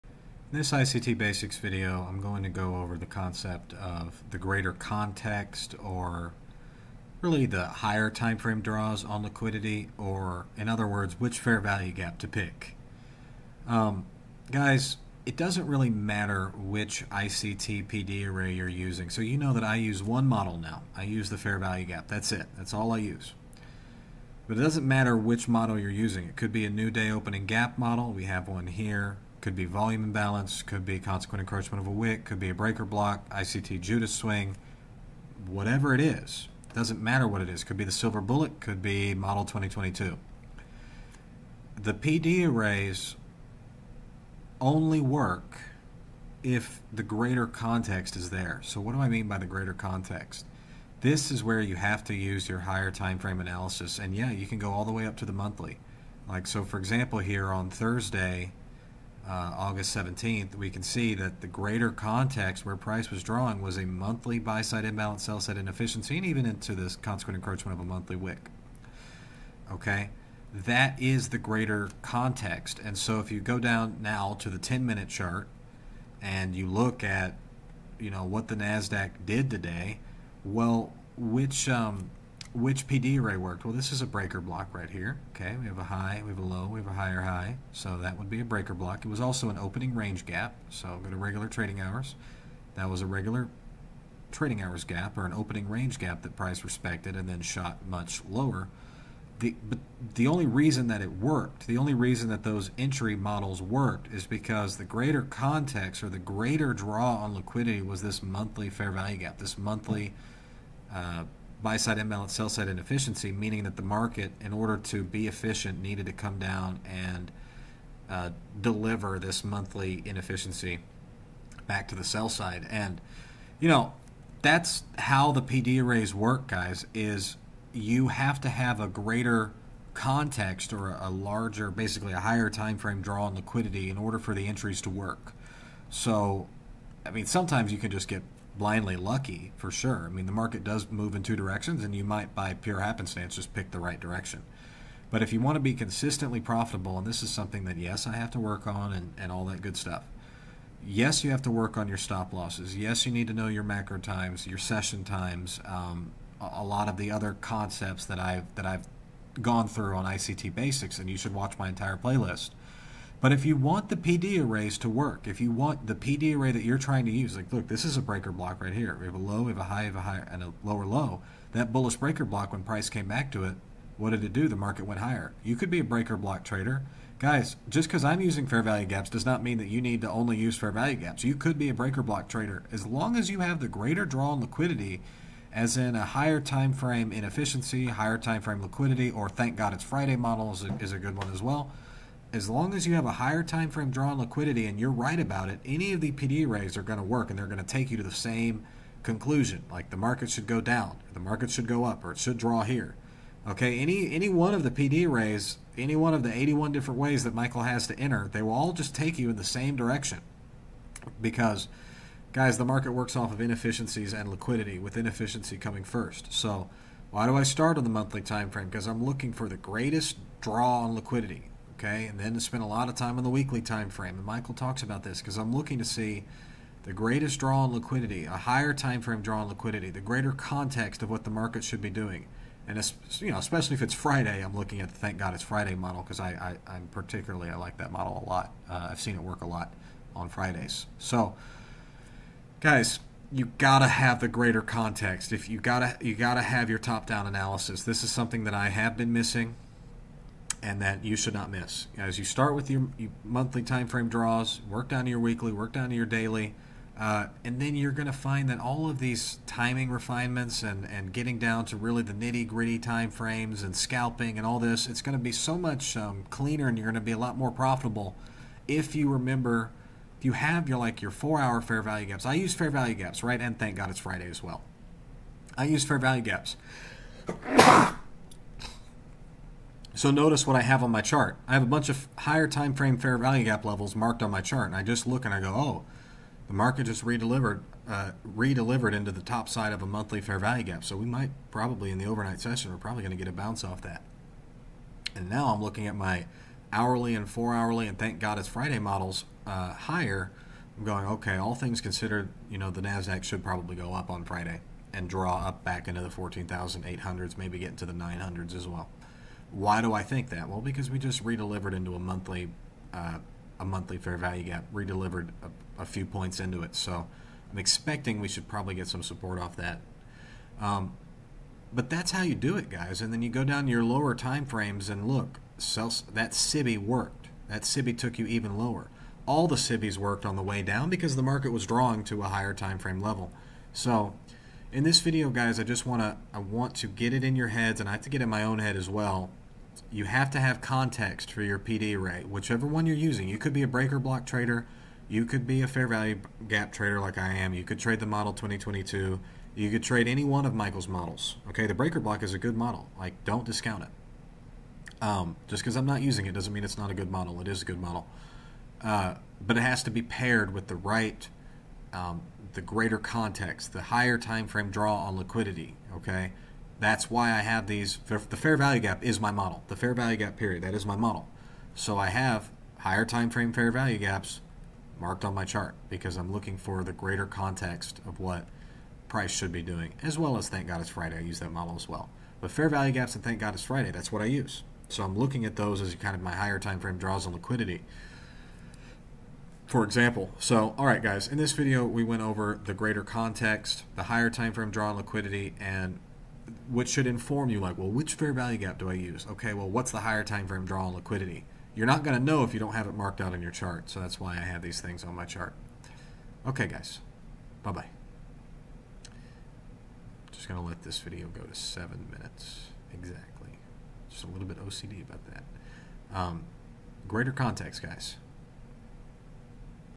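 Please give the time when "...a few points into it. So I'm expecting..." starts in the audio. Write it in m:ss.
5:15.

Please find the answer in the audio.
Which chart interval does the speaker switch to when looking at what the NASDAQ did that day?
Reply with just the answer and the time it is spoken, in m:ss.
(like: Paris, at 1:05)
10 minute, at 1:14.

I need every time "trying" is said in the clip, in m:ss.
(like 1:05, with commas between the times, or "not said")
2:46.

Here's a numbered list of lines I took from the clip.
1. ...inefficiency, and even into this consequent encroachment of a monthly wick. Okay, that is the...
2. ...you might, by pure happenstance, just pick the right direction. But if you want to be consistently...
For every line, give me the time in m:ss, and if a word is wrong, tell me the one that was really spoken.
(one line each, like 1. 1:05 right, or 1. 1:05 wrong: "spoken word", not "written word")
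1. 1:05 right
2. 2:21 right.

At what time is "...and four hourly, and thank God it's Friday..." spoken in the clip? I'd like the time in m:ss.
4:57.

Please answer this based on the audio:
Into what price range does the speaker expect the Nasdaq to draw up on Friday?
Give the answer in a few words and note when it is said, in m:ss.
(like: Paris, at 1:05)
14,800s, at 5:06.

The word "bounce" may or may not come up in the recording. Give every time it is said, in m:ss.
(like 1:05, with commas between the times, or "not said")
4:53.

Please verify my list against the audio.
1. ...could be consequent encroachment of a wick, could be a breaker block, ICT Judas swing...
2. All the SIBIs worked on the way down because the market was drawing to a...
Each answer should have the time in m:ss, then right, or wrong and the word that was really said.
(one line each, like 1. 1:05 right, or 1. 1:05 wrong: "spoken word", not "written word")
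1. 0:30 right
2. 5:29 right.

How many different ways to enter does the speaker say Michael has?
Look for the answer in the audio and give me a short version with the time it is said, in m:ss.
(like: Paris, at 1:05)
81, at 3:26.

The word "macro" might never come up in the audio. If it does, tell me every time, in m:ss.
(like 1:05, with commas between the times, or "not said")
2:33.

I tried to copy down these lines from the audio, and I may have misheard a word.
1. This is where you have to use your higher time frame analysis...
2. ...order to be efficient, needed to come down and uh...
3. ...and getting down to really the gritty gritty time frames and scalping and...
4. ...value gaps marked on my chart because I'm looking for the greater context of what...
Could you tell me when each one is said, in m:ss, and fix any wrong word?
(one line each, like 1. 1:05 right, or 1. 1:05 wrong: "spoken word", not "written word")
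1. 0:51 right
2. 1:54 right
3. 4:20 wrong: "nitty", not "gritty"
4. 6:13 right.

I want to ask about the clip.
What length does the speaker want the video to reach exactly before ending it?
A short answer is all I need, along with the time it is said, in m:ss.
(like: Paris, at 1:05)
seven minutes, at 6:51.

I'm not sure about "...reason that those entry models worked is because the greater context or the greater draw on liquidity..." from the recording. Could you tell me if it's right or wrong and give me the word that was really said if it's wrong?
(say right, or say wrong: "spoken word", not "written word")
right.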